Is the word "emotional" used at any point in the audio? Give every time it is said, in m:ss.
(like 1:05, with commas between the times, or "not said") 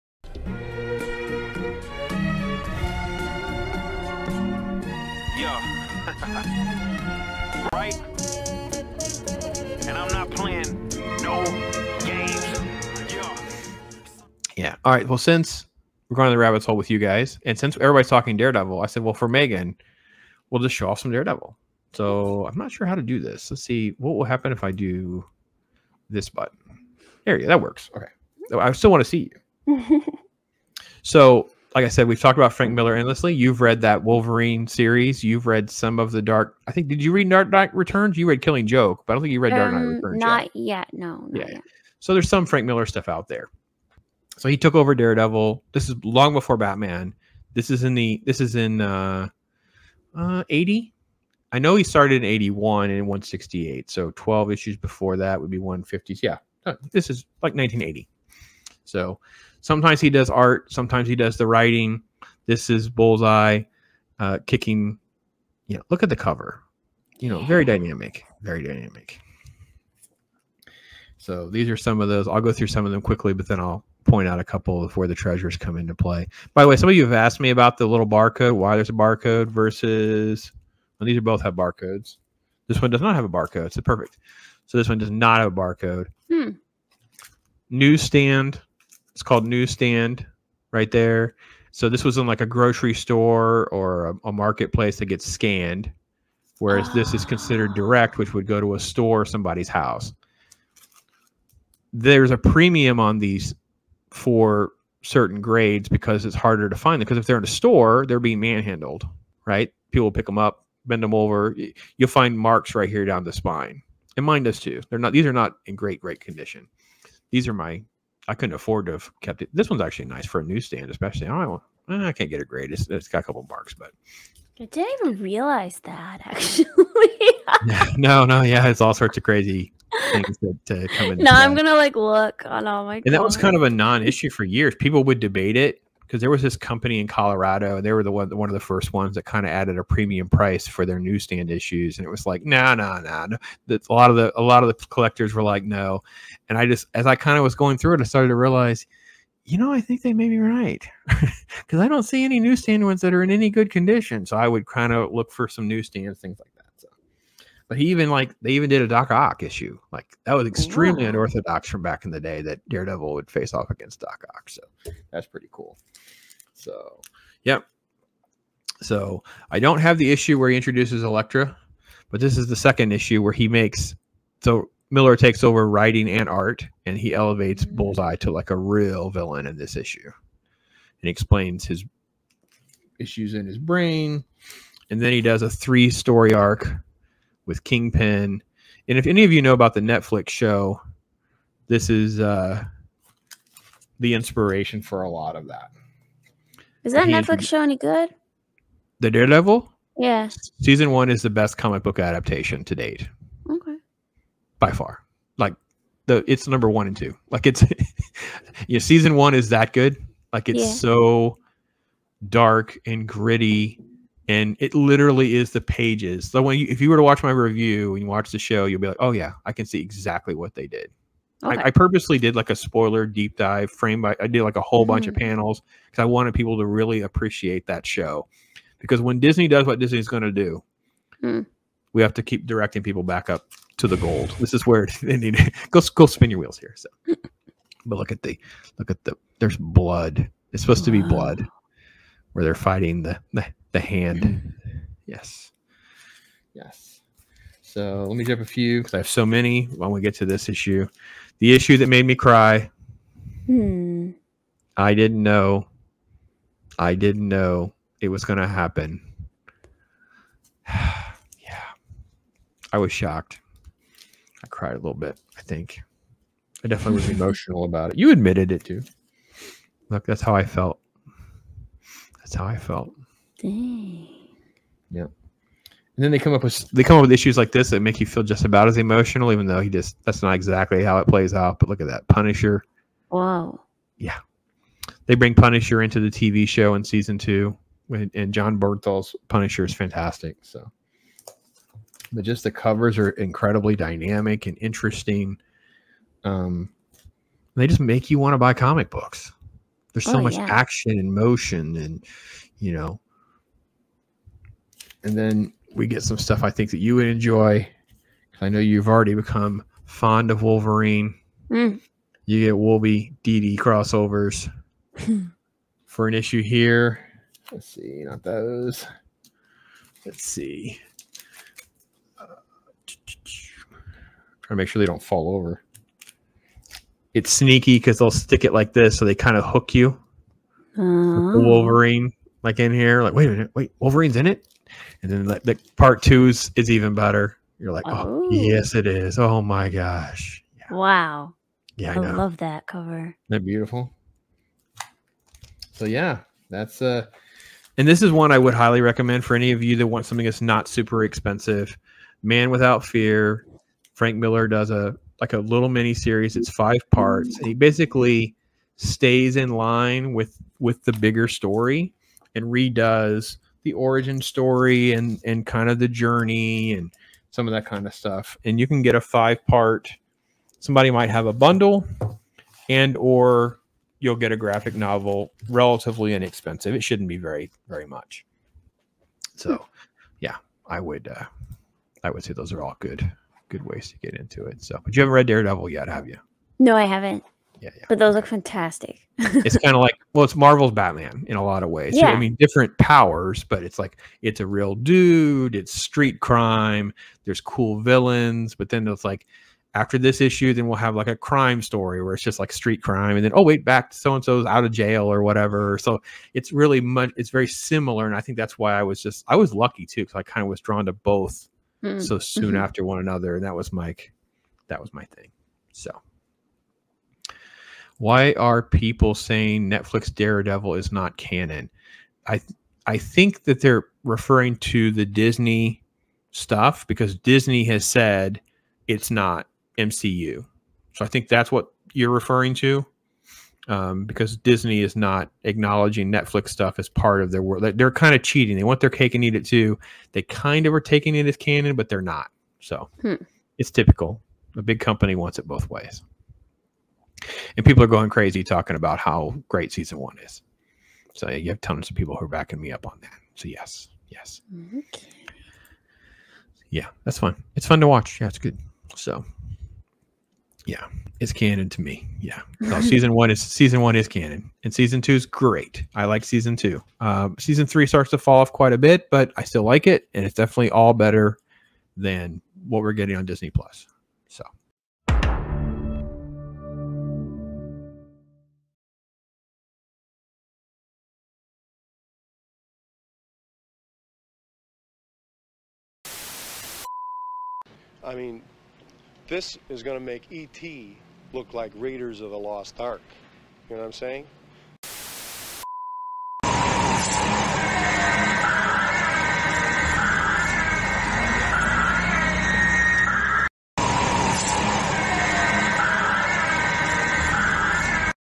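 4:27, 4:38.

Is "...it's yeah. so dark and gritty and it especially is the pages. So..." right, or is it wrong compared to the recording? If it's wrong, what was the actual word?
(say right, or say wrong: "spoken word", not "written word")
wrong: "literally", not "especially".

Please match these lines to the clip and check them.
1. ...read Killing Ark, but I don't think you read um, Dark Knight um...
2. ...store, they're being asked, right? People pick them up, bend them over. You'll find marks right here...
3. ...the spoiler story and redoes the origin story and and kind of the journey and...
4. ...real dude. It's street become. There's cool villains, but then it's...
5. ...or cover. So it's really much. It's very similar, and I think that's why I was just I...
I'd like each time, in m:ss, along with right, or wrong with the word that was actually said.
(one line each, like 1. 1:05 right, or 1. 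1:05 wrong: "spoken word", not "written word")
1. 0:38 wrong: "Joke", not "Ark"
2. 1:47 wrong: "manhandled", not "asked"
3. 6:00 wrong: "bigger", not "spoiler"
4. 6:34 wrong: "crime", not "become"
5. 6:45 wrong: "whatever", not "cover".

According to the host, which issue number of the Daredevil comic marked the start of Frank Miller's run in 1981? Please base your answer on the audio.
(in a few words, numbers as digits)
168.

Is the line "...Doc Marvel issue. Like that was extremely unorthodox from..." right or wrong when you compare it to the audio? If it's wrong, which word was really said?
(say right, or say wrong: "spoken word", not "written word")
wrong: "Ock", not "Marvel".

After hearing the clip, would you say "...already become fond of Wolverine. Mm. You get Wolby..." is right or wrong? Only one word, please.
right.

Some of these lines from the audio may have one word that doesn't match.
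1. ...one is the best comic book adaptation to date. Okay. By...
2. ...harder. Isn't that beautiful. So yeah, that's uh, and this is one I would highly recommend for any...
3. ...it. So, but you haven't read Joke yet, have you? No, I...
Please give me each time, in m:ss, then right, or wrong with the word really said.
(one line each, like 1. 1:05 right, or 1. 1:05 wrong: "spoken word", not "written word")
1. 3:20 right
2. 5:42 wrong: "cover", not "harder"
3. 6:24 wrong: "Daredevil", not "Joke".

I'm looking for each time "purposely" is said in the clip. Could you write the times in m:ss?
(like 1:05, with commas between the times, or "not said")
3:41.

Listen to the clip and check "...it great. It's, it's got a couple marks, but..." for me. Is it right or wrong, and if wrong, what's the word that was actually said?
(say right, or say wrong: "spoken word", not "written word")
right.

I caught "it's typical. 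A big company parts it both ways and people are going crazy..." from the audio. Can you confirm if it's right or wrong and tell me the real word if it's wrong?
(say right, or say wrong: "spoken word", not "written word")
wrong: "wants", not "parts".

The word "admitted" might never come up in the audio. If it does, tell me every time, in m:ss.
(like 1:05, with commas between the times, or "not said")
4:28.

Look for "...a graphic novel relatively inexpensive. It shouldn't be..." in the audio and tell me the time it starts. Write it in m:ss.
6:14.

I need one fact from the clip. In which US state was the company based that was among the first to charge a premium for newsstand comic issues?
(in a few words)
Colorado.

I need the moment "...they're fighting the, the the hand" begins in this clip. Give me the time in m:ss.
4:02.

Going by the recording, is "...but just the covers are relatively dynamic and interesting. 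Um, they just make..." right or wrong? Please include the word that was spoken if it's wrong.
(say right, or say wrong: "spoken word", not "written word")
wrong: "incredibly", not "relatively".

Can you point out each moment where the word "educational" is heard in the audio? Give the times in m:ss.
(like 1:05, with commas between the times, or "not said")
not said.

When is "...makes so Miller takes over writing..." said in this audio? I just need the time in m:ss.
2:53.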